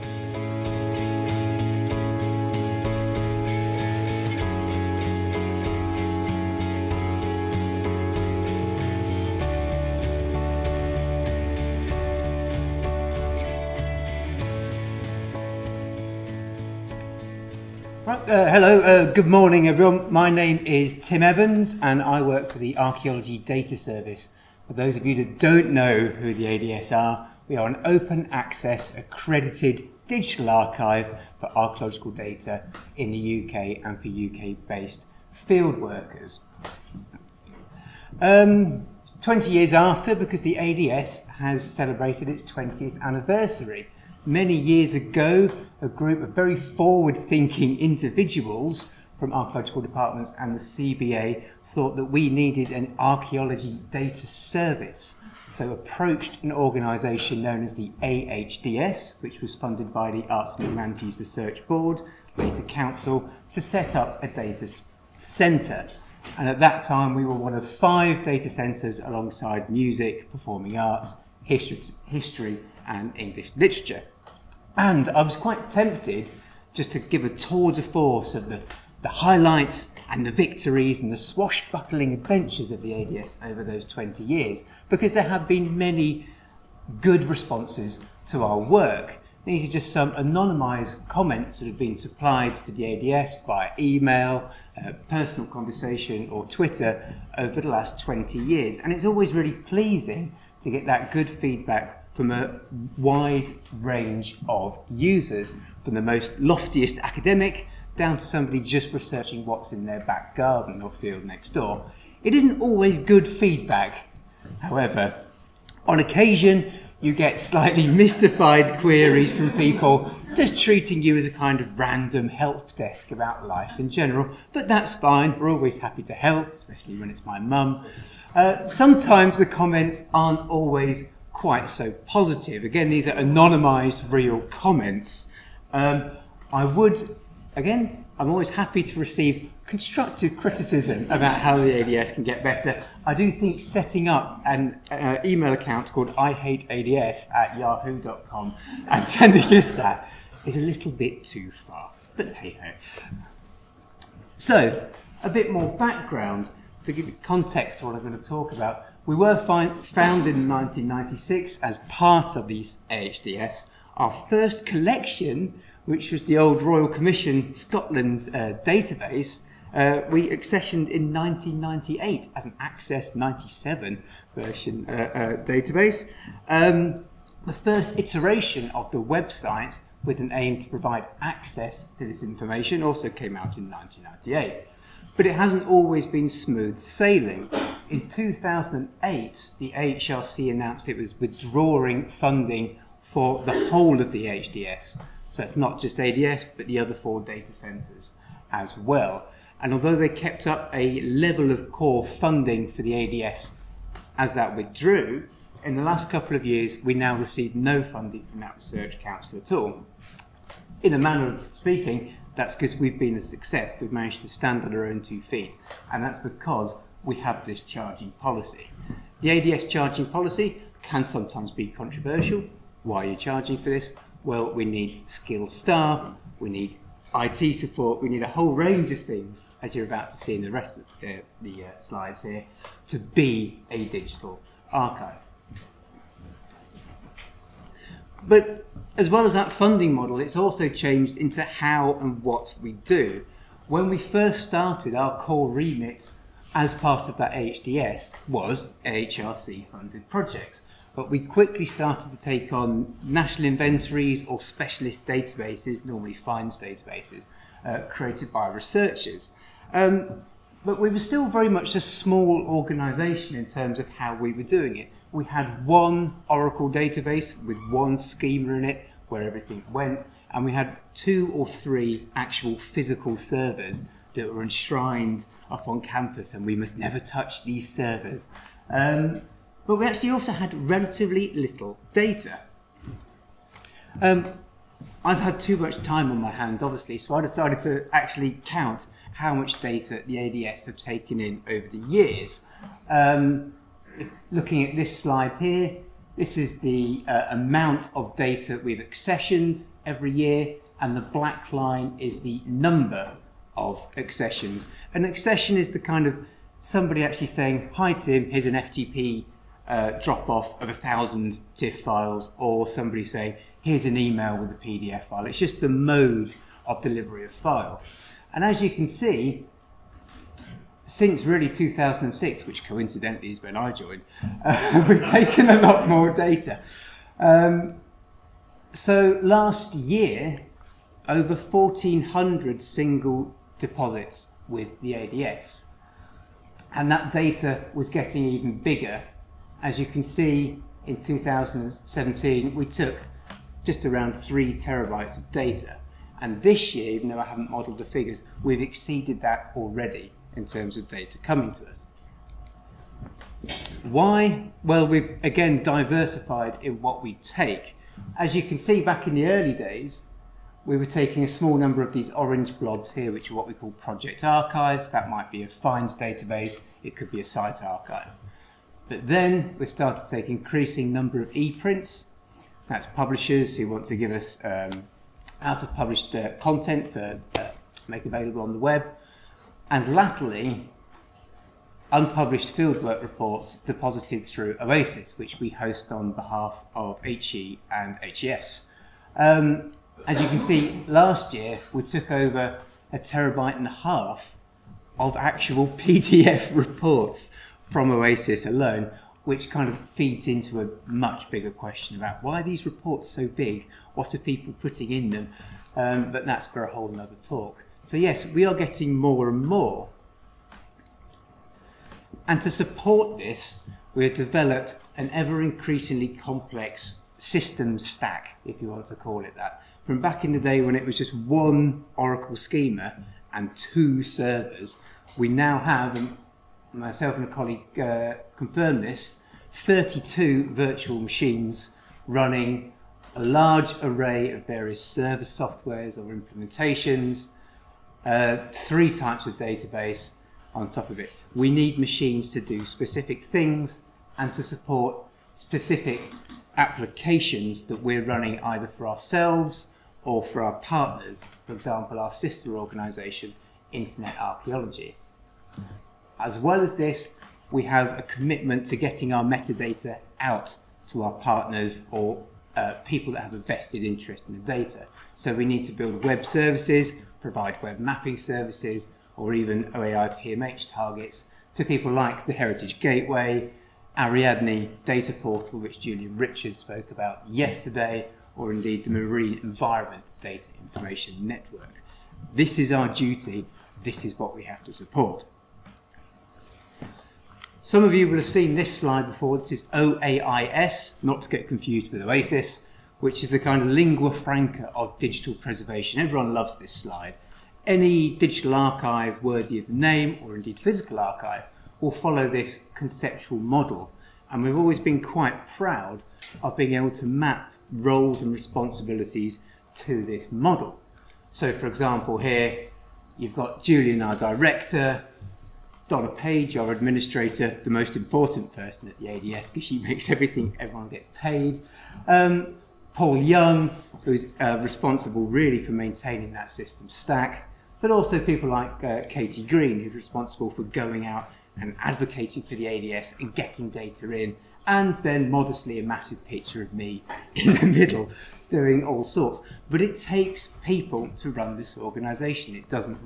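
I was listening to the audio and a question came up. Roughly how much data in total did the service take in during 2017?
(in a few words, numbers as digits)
3 terabytes.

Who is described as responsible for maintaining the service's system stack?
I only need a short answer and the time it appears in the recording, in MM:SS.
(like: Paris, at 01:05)
Paul Young, at 08:42.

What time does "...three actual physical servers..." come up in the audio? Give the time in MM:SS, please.
04:31.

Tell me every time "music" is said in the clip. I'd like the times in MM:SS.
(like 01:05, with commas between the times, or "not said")
01:09.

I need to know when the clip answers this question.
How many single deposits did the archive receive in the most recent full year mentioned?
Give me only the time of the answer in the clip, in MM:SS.
05:31.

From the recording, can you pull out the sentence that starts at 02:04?
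But that's fine, we're always happy to help, especially when it's my mum.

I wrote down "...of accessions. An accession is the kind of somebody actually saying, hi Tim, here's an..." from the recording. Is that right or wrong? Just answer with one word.
right.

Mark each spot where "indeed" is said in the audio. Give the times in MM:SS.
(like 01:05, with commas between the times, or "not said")
07:58, 08:20.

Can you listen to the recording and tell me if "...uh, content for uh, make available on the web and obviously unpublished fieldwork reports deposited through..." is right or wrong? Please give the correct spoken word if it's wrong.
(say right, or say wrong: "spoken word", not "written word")
wrong: "latterly", not "obviously".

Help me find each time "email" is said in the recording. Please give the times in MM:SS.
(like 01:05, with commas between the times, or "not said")
01:33, 02:25, 05:13.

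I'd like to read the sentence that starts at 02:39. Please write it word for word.
We were founded in 1996 as part of the AHDS.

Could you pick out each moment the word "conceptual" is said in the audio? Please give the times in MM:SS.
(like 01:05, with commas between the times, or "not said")
08:22.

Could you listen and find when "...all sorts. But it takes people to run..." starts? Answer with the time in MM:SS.
08:58.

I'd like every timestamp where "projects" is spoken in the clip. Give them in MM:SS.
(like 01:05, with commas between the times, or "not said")
04:10, 06:03.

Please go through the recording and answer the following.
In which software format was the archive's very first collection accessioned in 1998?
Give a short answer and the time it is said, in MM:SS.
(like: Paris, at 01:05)
Access 97, at 02:52.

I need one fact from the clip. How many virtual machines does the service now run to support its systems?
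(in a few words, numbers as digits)
32.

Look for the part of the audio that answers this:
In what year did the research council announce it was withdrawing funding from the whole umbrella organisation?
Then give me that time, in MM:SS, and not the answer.
03:08.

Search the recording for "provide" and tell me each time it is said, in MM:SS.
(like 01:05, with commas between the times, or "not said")
03:00, 07:47.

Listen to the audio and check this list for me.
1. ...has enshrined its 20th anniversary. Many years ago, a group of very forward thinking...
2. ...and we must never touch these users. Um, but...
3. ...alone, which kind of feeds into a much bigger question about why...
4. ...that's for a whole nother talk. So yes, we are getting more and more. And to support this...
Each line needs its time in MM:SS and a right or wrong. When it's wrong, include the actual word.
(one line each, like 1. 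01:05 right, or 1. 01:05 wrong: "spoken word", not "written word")
1. 00:41 wrong: "celebrated", not "enshrined"
2. 04:36 wrong: "servers", not "users"
3. 06:38 right
4. 06:46 right.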